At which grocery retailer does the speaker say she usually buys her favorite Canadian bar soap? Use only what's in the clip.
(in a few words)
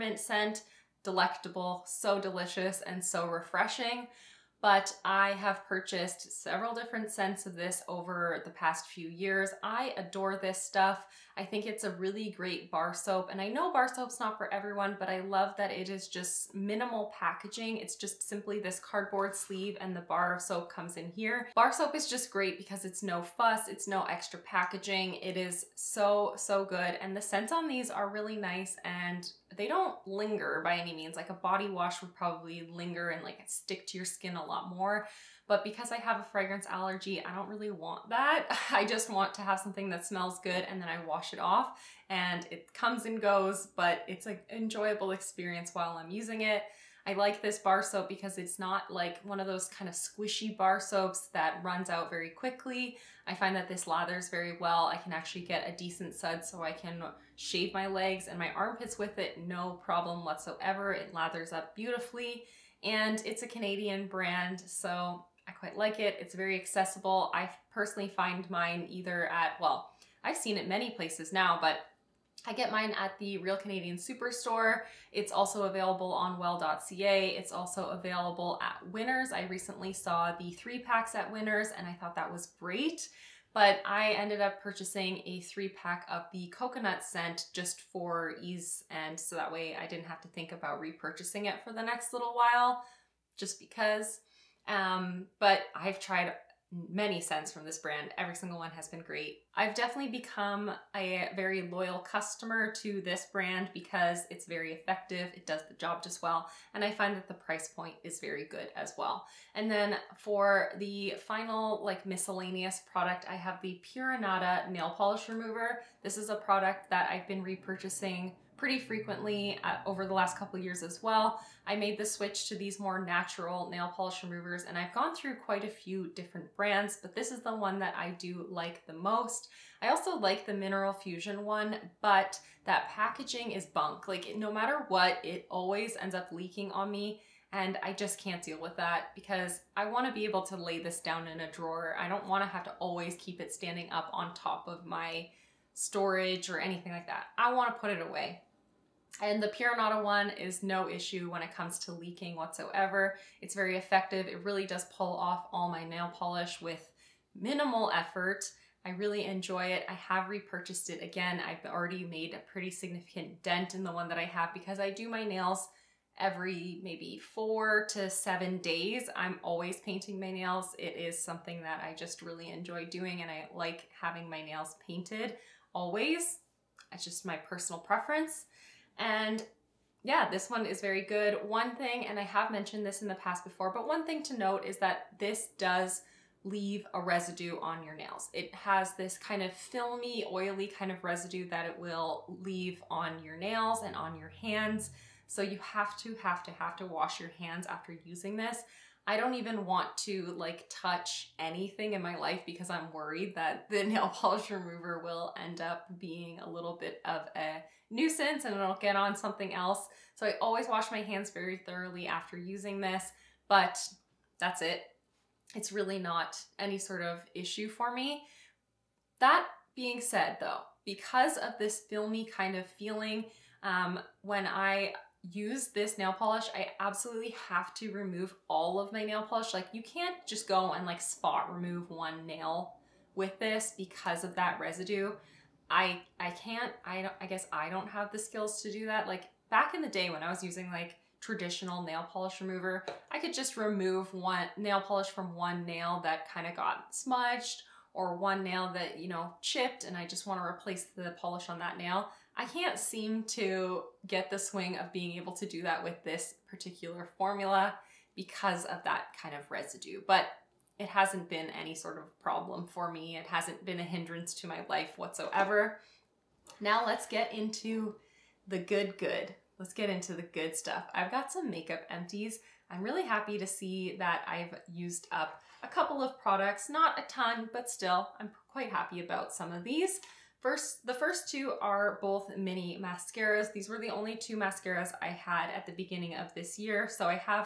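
Real Canadian Superstore.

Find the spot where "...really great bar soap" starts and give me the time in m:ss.
0:11.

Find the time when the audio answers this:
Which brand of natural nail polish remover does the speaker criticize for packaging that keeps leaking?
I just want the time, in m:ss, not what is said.
2:10.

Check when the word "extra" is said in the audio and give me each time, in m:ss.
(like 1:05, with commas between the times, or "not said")
0:24.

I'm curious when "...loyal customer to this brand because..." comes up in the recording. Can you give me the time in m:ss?
1:41.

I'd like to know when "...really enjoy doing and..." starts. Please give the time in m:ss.
2:52.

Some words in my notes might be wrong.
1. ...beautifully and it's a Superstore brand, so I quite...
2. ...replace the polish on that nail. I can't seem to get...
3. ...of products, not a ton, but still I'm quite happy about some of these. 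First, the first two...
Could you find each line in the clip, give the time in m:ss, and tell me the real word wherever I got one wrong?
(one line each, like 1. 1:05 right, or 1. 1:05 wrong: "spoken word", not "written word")
1. 1:01 wrong: "Canadian", not "Superstore"
2. 4:10 right
3. 4:35 right.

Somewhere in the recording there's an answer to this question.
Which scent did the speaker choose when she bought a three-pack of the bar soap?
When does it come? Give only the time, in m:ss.
1:26.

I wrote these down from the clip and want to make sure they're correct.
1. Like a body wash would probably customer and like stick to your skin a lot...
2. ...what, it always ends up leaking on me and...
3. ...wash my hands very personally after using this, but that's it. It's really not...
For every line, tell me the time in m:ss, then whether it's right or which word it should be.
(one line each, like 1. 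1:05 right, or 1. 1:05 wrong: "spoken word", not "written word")
1. 0:31 wrong: "linger", not "customer"
2. 2:14 right
3. 3:30 wrong: "thoroughly", not "personally".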